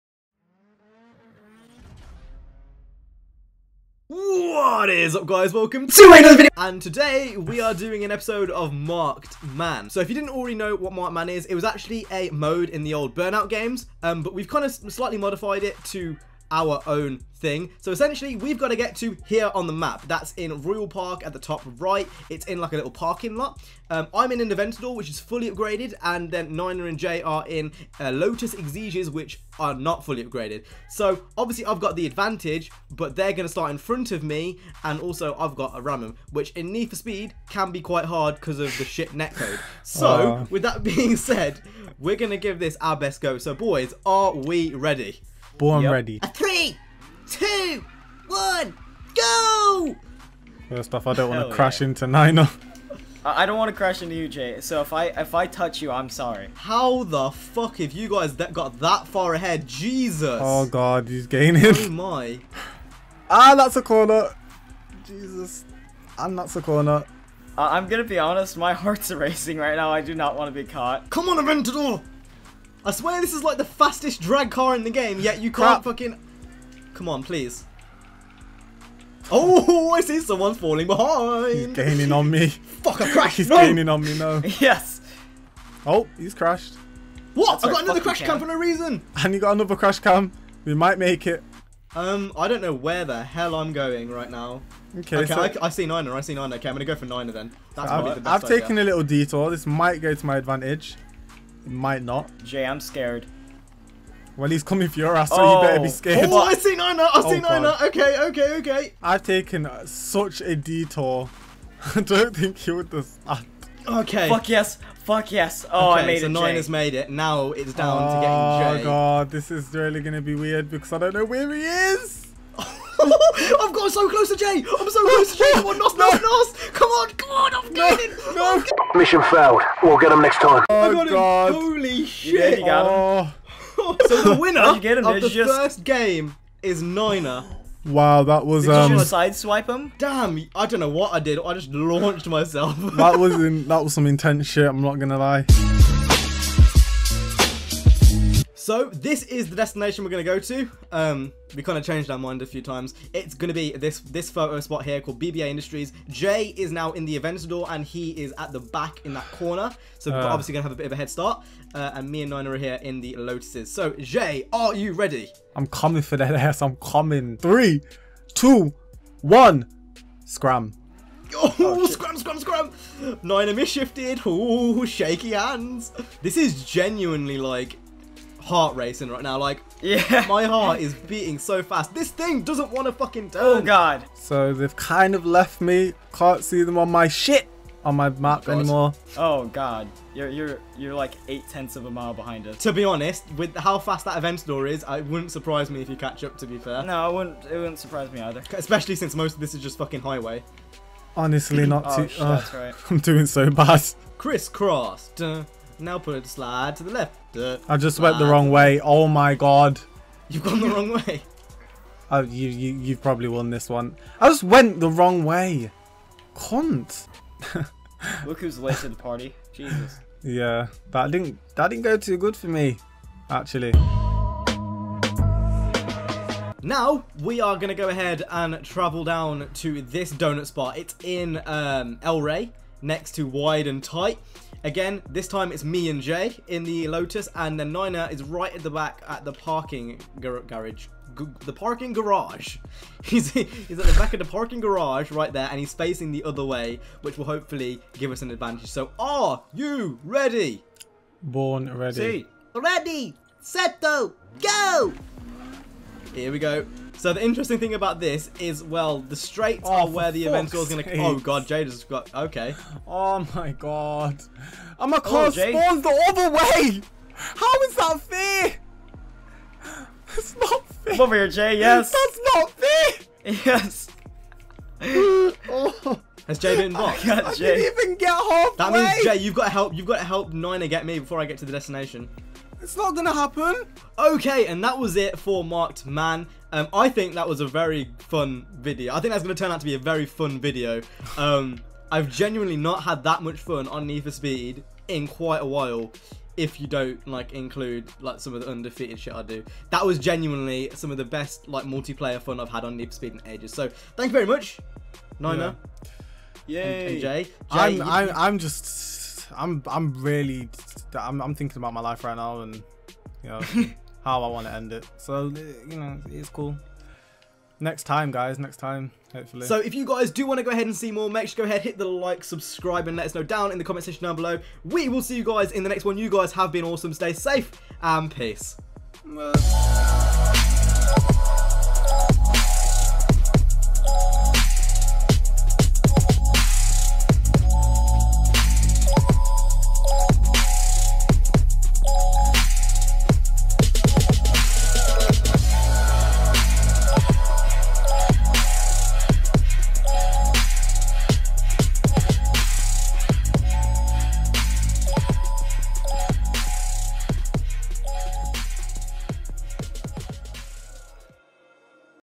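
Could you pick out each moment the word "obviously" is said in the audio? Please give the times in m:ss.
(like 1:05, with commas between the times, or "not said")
0:31, 2:40.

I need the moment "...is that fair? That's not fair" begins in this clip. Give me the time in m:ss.
4:27.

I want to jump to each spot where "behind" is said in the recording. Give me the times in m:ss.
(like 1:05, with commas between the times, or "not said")
1:20, 3:12.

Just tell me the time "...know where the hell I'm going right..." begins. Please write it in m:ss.
1:32.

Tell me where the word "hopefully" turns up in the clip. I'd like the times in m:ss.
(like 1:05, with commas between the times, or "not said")
4:07, 5:19.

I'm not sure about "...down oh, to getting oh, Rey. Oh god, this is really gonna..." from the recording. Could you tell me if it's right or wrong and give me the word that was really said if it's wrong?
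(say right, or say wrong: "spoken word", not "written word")
wrong: "Jay", not "Rey".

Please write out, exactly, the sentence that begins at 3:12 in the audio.
To be honest, with how fast that Aventador is, it wouldn't surprise me if you catch up.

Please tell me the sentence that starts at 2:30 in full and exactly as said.
Um, we kind of changed our mind a few times.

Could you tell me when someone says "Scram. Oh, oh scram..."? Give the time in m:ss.
2:50.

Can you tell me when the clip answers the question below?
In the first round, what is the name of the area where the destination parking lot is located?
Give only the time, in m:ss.
0:20.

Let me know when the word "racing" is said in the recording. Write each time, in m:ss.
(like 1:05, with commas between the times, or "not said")
1:09, 2:58.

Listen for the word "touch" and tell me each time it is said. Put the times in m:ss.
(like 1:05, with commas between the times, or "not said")
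0:55.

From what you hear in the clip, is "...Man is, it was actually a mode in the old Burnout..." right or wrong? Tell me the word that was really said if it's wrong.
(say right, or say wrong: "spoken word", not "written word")
right.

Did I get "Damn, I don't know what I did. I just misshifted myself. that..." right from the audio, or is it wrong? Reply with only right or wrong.
wrong.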